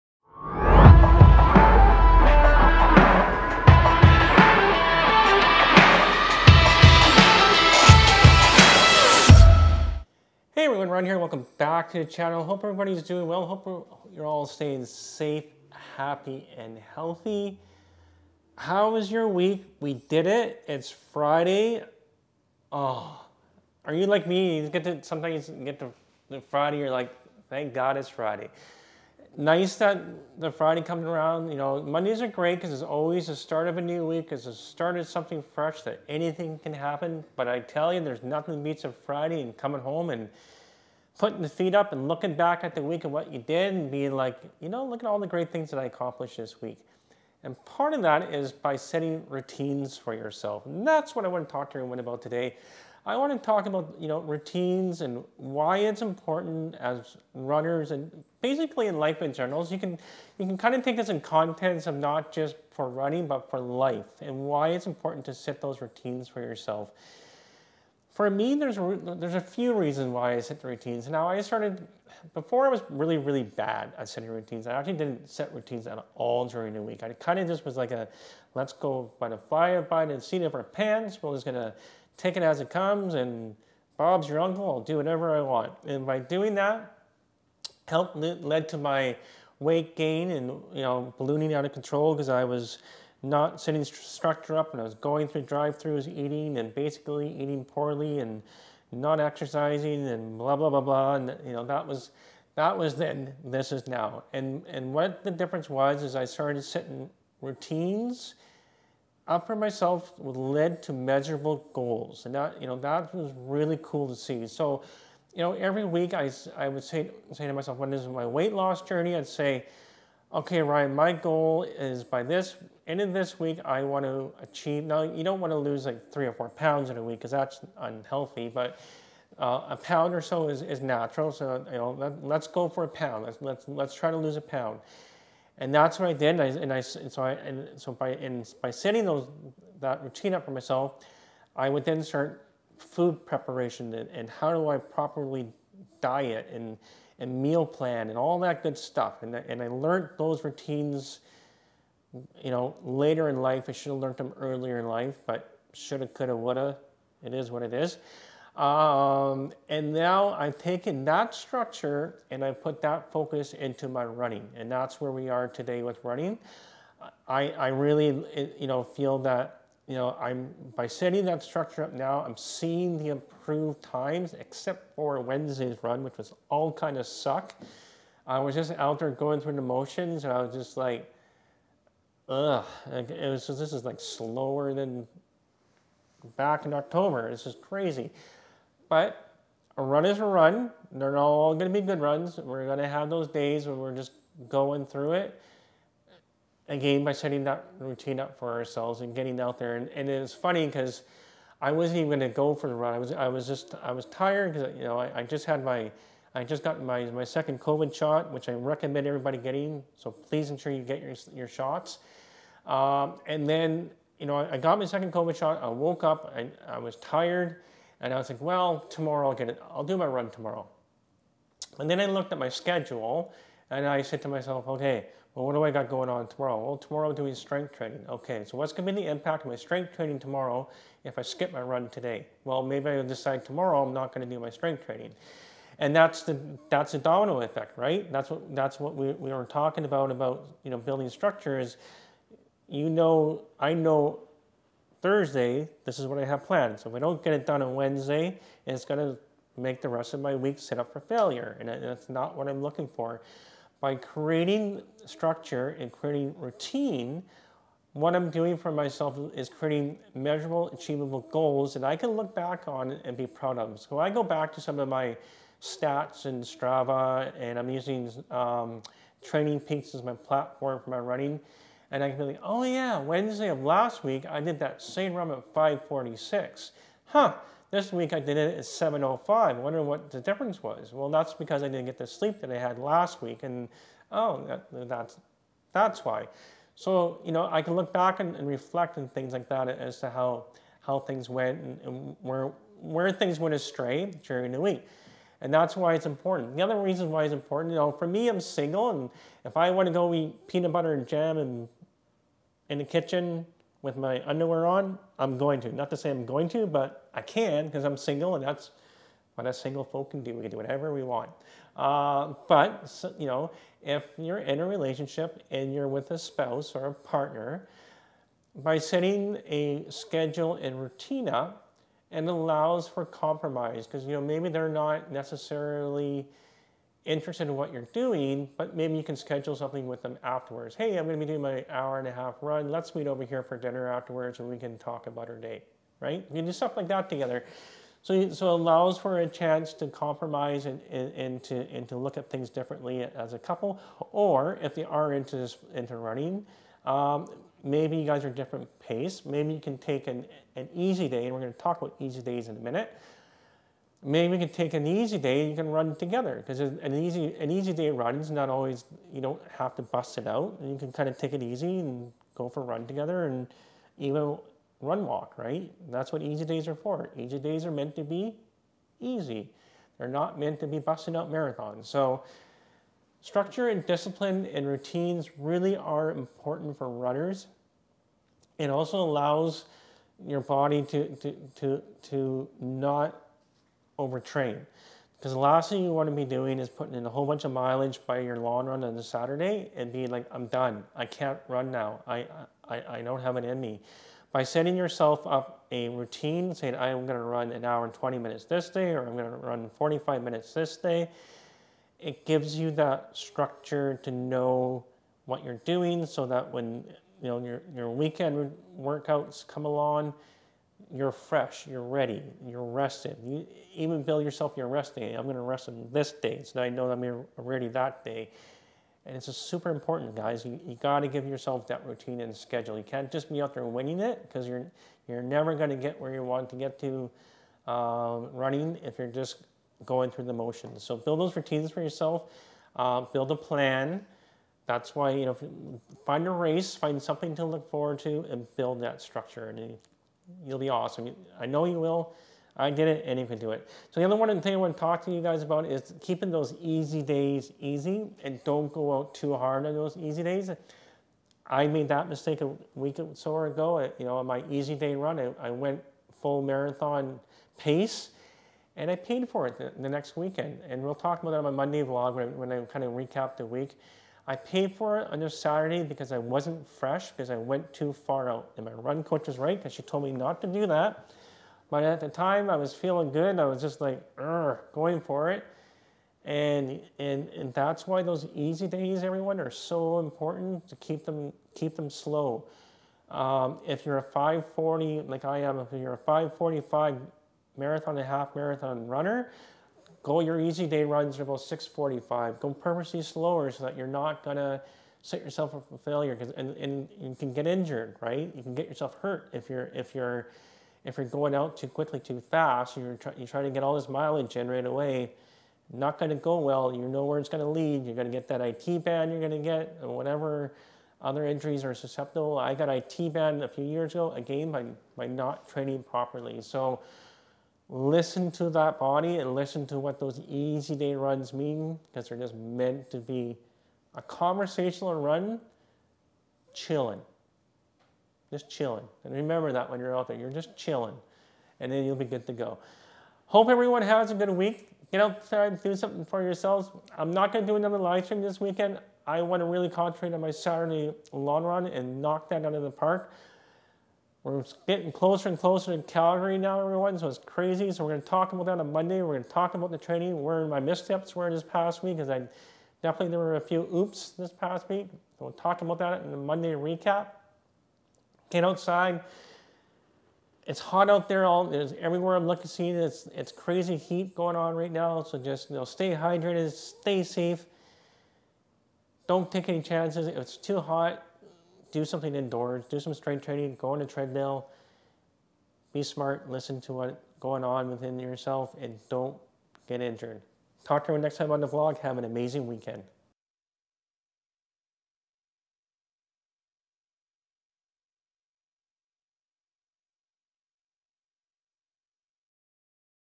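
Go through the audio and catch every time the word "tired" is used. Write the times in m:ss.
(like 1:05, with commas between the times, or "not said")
3:24, 3:36.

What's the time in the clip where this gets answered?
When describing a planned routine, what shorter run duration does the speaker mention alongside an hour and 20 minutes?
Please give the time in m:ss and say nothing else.
6:39.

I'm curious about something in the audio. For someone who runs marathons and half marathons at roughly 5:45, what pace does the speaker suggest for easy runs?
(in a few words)
6:45.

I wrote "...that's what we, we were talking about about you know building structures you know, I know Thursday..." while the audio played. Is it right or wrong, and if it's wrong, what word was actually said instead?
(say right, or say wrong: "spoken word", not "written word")
right.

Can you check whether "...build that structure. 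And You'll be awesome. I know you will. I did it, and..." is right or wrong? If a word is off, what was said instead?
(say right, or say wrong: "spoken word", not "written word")
right.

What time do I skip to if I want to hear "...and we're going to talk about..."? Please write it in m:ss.
5:51.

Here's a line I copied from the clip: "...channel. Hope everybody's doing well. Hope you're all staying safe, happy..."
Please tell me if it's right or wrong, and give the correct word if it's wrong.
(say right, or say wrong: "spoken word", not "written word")
right.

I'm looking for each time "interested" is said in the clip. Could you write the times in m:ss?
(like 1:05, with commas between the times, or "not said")
5:27.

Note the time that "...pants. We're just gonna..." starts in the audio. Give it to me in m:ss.
1:20.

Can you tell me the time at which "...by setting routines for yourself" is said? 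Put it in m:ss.
0:48.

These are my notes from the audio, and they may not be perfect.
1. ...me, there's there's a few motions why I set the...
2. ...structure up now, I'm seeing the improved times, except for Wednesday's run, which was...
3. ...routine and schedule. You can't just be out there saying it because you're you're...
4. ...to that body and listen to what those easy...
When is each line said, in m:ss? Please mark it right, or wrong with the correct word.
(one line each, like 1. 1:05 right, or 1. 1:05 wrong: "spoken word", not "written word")
1. 1:08 wrong: "reasons", not "motions"
2. 2:51 right
3. 7:01 wrong: "winning", not "saying"
4. 8:38 right.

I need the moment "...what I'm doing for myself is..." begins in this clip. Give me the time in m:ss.
4:17.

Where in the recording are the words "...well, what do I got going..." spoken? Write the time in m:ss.
3:45.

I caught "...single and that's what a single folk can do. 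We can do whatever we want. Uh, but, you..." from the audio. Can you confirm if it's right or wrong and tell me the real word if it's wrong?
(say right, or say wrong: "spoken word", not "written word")
right.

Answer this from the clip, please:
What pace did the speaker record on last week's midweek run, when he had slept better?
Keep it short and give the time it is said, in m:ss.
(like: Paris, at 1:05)
5:46, at 4:35.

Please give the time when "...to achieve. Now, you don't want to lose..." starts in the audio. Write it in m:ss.
2:04.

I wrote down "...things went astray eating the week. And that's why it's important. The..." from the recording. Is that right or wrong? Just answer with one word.
wrong.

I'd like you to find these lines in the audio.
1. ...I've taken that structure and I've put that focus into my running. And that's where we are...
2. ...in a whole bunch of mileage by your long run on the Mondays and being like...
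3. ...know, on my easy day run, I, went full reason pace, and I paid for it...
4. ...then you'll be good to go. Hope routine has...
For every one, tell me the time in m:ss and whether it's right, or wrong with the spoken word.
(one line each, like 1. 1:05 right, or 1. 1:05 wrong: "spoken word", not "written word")
1. 2:40 right
2. 6:26 wrong: "Saturday", not "Mondays"
3. 7:34 wrong: "marathon", not "reason"
4. 8:51 wrong: "everyone", not "routine".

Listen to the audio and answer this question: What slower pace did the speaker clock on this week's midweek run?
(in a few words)
7:05.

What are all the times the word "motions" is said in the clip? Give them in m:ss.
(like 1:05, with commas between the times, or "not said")
2:59, 7:10.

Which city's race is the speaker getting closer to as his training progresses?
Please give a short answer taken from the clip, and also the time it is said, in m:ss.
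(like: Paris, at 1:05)
Calgary, at 9:05.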